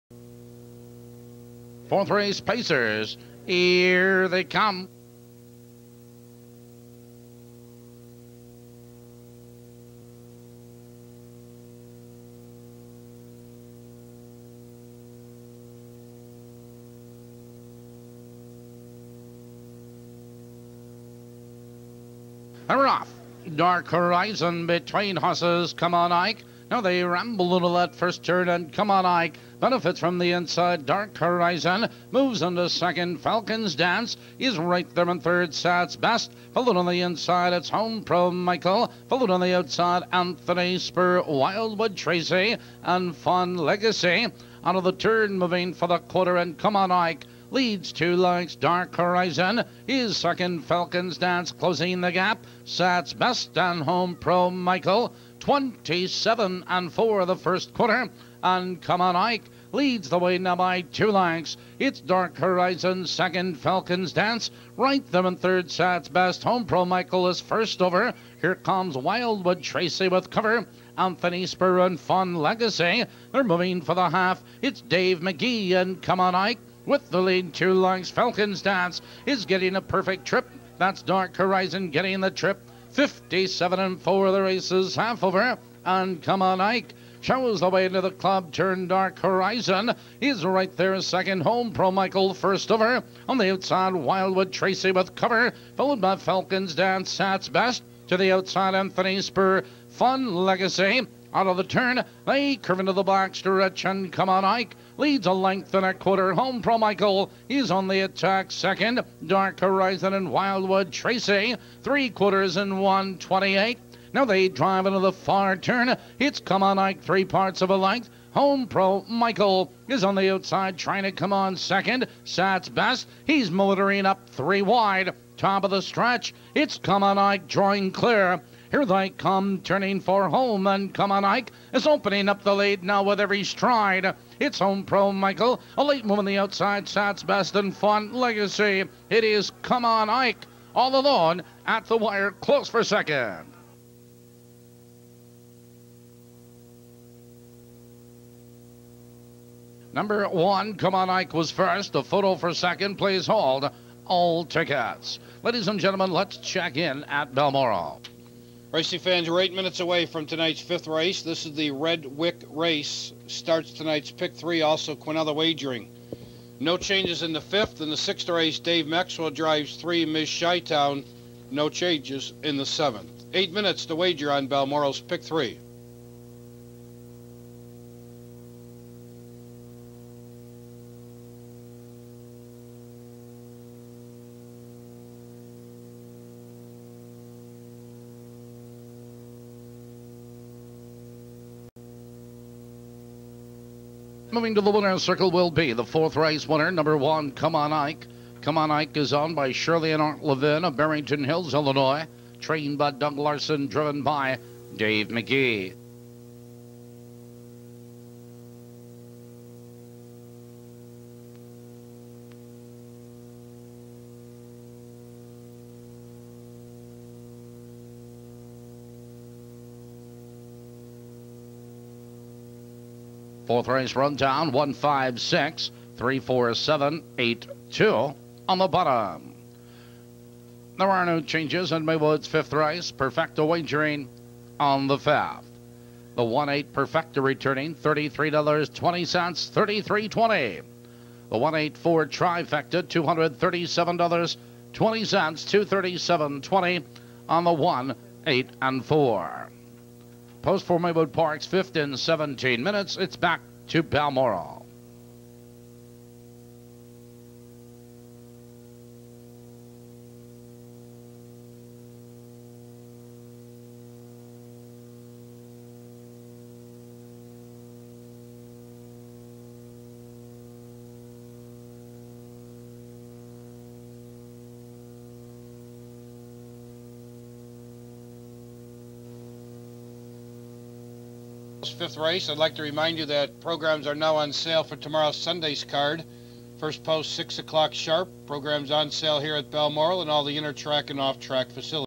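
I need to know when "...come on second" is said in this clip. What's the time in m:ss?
2:01.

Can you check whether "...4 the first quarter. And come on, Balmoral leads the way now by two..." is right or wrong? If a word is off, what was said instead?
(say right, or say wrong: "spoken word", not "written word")
wrong: "Ike", not "Balmoral".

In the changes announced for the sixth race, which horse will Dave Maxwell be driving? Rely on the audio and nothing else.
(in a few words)
Ms. Shytown.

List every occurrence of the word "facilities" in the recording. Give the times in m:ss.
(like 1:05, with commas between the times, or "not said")
4:51.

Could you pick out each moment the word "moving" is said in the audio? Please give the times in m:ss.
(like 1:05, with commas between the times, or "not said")
0:45, 1:13, 3:14.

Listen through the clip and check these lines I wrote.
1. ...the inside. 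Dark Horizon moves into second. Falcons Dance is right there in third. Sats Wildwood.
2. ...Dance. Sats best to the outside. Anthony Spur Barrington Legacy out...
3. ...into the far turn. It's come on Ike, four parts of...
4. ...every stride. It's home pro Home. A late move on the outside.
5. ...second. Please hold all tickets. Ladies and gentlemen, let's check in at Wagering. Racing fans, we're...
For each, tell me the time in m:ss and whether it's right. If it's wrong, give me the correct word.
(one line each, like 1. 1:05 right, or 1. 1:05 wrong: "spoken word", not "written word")
1. 0:30 wrong: "Best", not "Wildwood"
2. 1:36 wrong: "Fun", not "Barrington"
3. 1:54 wrong: "three", not "four"
4. 2:13 wrong: "Michael", not "Home"
5. 2:32 wrong: "Balmoral", not "Wagering".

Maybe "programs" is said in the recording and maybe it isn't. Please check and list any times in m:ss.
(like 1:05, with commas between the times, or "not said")
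4:43, 4:48.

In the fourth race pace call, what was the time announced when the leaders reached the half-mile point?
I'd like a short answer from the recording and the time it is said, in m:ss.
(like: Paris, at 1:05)
57 and 4, at 1:22.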